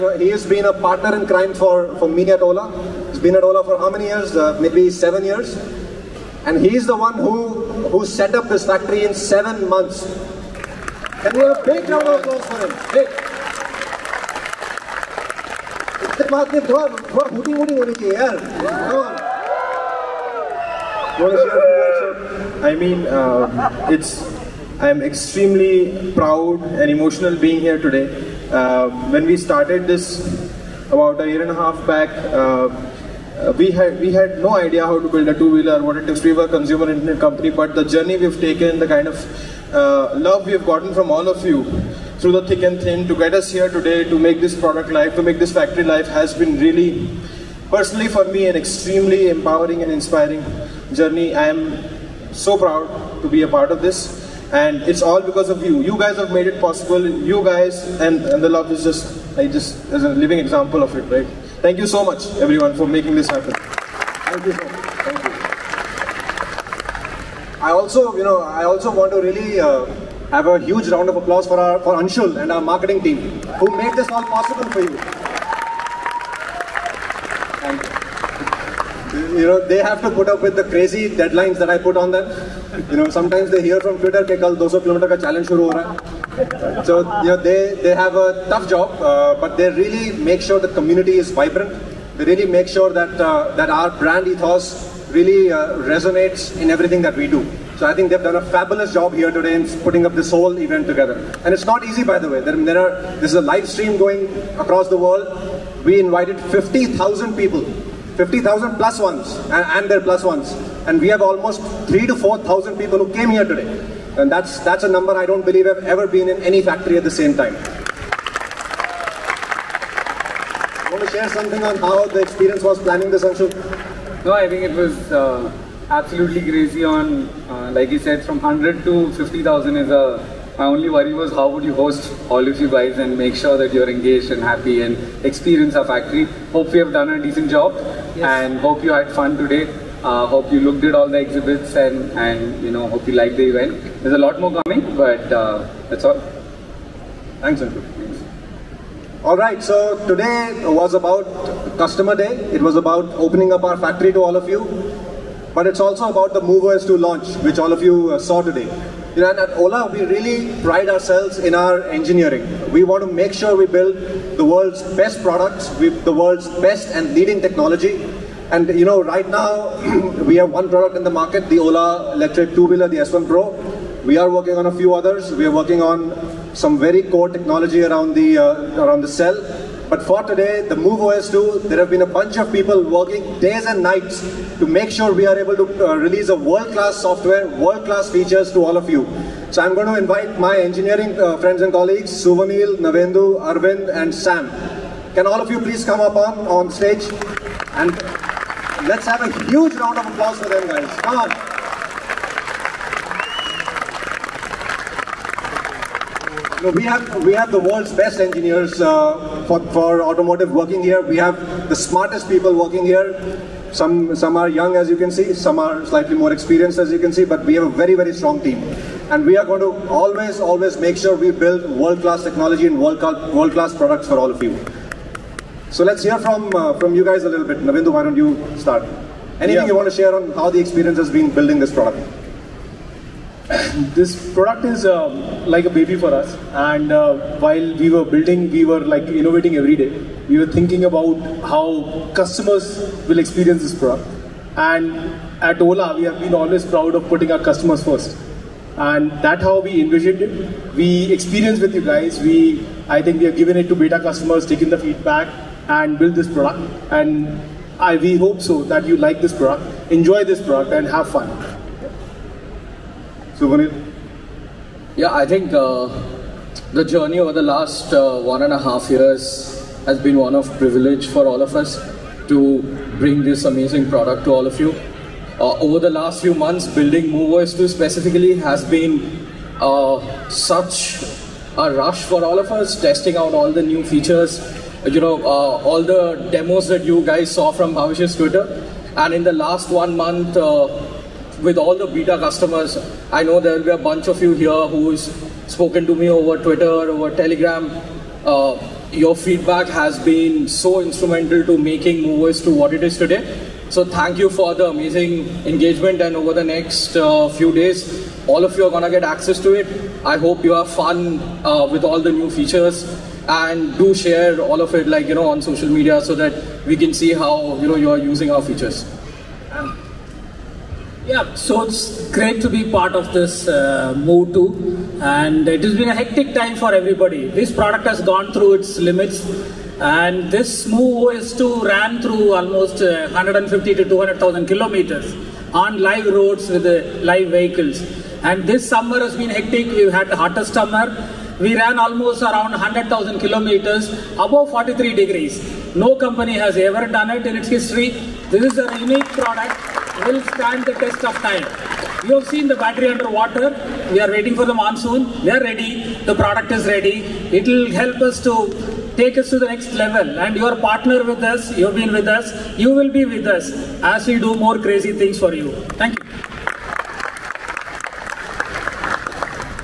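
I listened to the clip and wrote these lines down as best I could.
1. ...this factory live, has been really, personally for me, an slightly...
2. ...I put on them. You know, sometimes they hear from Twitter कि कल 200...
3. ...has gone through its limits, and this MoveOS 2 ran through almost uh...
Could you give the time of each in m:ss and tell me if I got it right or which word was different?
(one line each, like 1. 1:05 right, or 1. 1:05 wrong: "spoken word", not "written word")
1. 0:45 wrong: "extremely", not "slightly"
2. 1:21 right
3. 5:27 right.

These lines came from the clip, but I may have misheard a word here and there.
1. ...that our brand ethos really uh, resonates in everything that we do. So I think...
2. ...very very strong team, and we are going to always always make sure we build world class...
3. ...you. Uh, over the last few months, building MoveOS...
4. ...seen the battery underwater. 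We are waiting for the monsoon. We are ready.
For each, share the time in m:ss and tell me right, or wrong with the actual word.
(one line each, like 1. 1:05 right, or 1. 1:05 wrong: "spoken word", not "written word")
1. 1:33 right
2. 3:37 right
3. 4:34 right
4. 5:52 right.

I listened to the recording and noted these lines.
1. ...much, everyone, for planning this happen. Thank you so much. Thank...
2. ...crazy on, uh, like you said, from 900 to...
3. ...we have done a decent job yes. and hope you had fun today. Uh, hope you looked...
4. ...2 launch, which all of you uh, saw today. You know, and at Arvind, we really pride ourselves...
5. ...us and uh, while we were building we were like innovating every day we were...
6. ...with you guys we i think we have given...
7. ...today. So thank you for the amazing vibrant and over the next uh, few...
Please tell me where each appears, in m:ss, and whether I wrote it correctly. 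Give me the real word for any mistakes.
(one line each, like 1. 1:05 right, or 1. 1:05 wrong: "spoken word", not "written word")
1. 1:02 wrong: "making", not "planning"
2. 2:06 wrong: "100", not "900"
3. 2:16 right
4. 2:36 wrong: "Ola", not "Arvind"
5. 3:56 right
6. 4:11 right
7. 5:02 wrong: "engagement", not "vibrant".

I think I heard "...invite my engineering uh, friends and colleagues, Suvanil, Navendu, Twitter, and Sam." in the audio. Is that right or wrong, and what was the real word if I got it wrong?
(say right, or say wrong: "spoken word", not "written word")
wrong: "Arvind", not "Twitter".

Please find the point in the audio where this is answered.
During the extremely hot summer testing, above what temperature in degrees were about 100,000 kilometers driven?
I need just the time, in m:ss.
5:44.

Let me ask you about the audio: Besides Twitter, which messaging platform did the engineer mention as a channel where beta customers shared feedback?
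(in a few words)
Telegram.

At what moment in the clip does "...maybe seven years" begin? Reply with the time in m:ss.
0:04.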